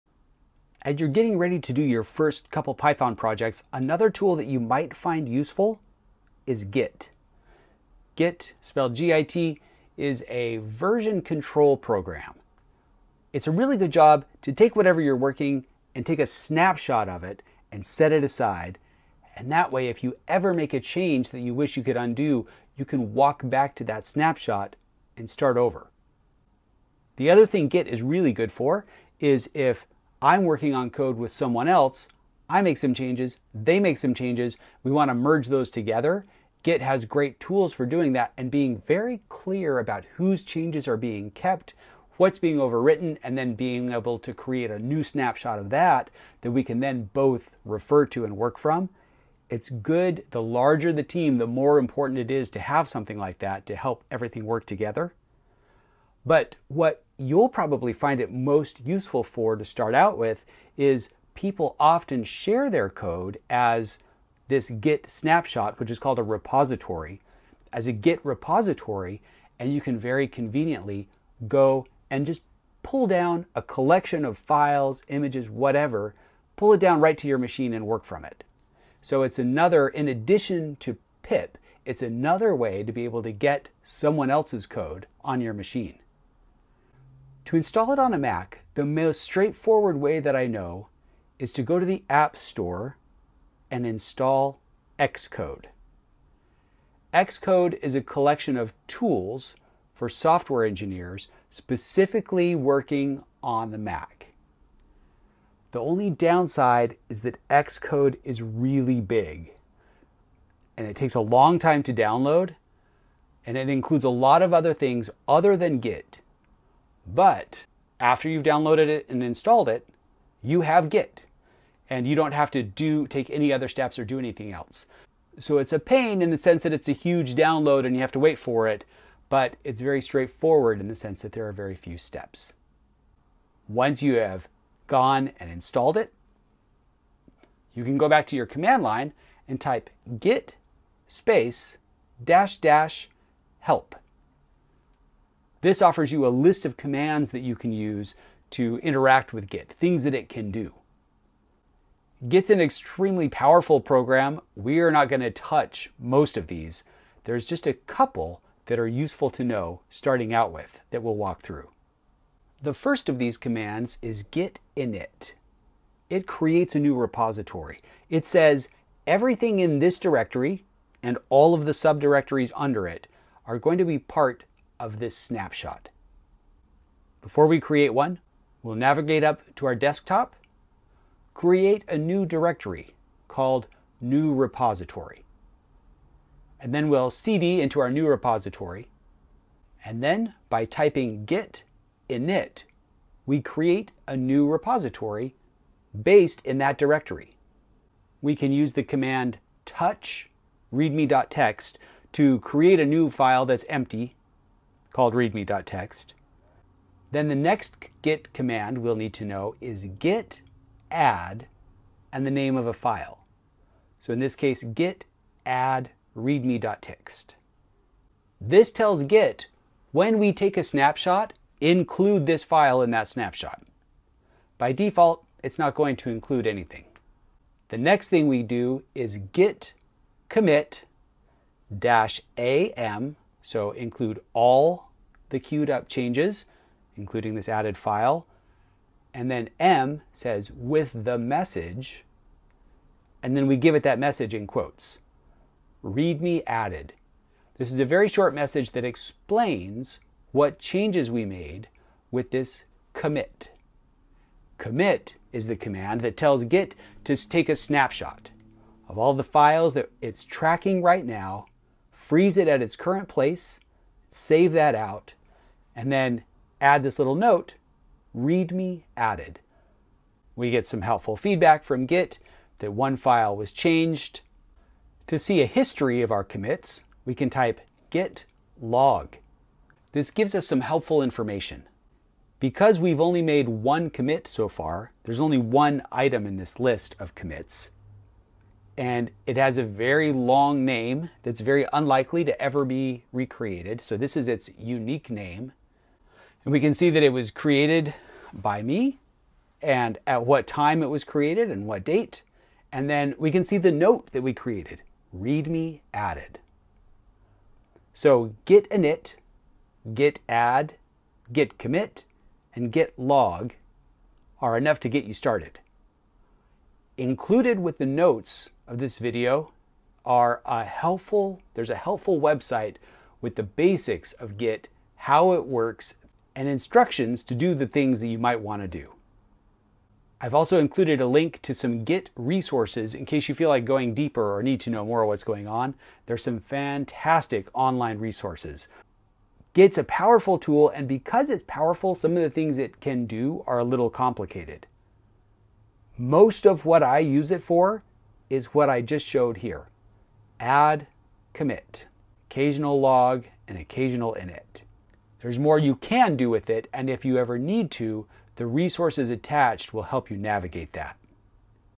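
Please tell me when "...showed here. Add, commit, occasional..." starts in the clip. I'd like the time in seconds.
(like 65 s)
349 s.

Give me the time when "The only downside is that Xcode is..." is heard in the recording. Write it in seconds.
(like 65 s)
105 s.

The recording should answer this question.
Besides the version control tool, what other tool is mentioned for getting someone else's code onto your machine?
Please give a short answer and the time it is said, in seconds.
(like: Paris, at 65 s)
pip, at 81 s.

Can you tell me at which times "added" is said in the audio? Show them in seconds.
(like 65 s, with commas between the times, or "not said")
237 s, 246 s, 268 s, 305 s.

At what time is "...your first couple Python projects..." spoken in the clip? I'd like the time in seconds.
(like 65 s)
1 s.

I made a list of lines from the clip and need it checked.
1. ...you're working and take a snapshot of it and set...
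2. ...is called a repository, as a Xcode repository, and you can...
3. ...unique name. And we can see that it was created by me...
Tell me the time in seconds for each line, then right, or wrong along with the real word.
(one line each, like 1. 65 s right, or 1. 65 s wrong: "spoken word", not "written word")
1. 14 s right
2. 65 s wrong: "Git", not "Xcode"
3. 294 s right.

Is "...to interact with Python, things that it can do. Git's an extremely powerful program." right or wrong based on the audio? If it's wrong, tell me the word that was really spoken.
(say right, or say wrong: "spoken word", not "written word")
wrong: "Git", not "Python".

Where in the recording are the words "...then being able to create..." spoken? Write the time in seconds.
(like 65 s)
43 s.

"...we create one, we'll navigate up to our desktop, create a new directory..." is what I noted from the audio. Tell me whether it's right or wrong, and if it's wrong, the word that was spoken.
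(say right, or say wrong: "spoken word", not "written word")
right.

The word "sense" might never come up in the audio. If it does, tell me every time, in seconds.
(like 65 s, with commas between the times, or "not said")
126 s, 130 s.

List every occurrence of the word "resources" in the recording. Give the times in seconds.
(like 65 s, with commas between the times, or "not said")
332 s, 337 s, 358 s.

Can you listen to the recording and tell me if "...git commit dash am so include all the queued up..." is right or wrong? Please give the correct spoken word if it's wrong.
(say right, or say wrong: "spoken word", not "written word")
right.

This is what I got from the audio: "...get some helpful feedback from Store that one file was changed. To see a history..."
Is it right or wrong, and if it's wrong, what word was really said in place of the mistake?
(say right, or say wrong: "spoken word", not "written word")
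wrong: "Git", not "Store".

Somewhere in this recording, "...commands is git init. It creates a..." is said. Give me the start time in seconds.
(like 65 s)
163 s.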